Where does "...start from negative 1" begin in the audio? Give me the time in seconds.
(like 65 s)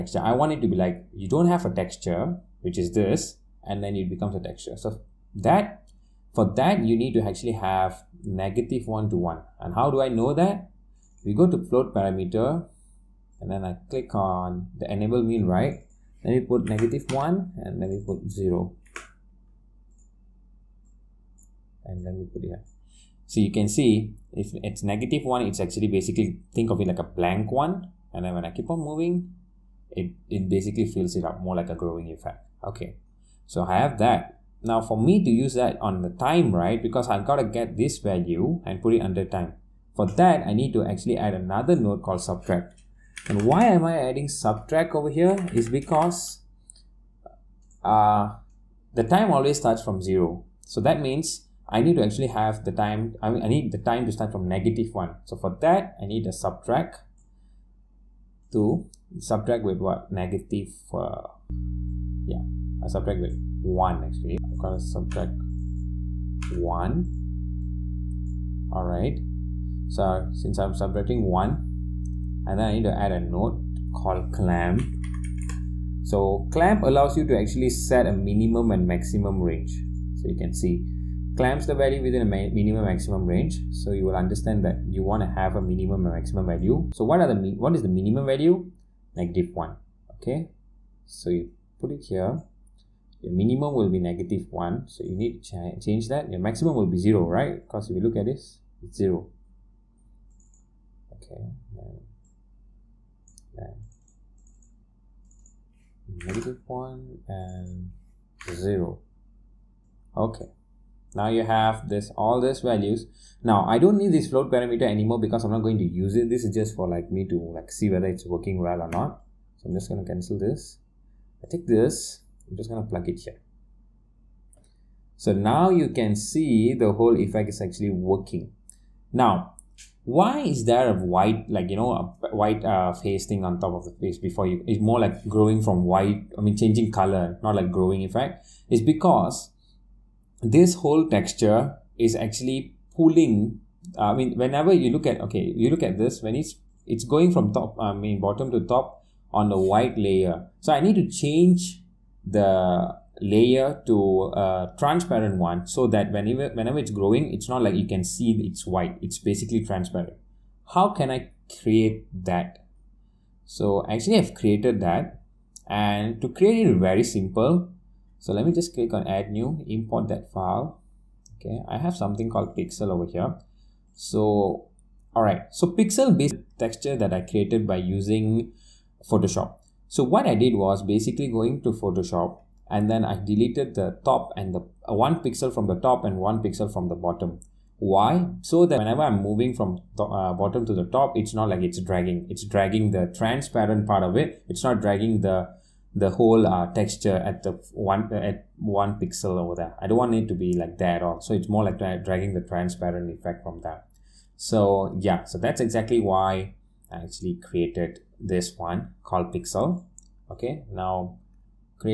54 s.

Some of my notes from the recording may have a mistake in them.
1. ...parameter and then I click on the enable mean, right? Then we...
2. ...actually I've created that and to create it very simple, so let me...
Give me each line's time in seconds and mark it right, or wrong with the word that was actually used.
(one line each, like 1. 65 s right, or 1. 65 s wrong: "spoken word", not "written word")
1. 11 s right
2. 163 s right.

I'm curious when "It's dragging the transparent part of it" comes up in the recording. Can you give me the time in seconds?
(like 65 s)
192 s.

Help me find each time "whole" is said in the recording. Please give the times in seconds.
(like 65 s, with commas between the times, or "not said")
126 s, 140 s, 196 s.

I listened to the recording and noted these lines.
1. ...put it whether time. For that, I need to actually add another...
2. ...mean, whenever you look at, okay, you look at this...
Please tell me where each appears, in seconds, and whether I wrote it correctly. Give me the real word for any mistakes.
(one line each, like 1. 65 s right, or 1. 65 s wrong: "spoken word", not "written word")
1. 38 s wrong: "under", not "whether"
2. 144 s right.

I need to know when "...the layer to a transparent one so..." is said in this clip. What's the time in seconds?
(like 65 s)
152 s.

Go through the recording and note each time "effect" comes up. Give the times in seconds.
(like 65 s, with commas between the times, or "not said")
32 s, 127 s, 138 s, 203 s.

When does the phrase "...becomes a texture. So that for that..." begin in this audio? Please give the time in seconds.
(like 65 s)
4 s.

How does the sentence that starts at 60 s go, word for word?
Negative, uh, yeah, I subtract with 1 actually.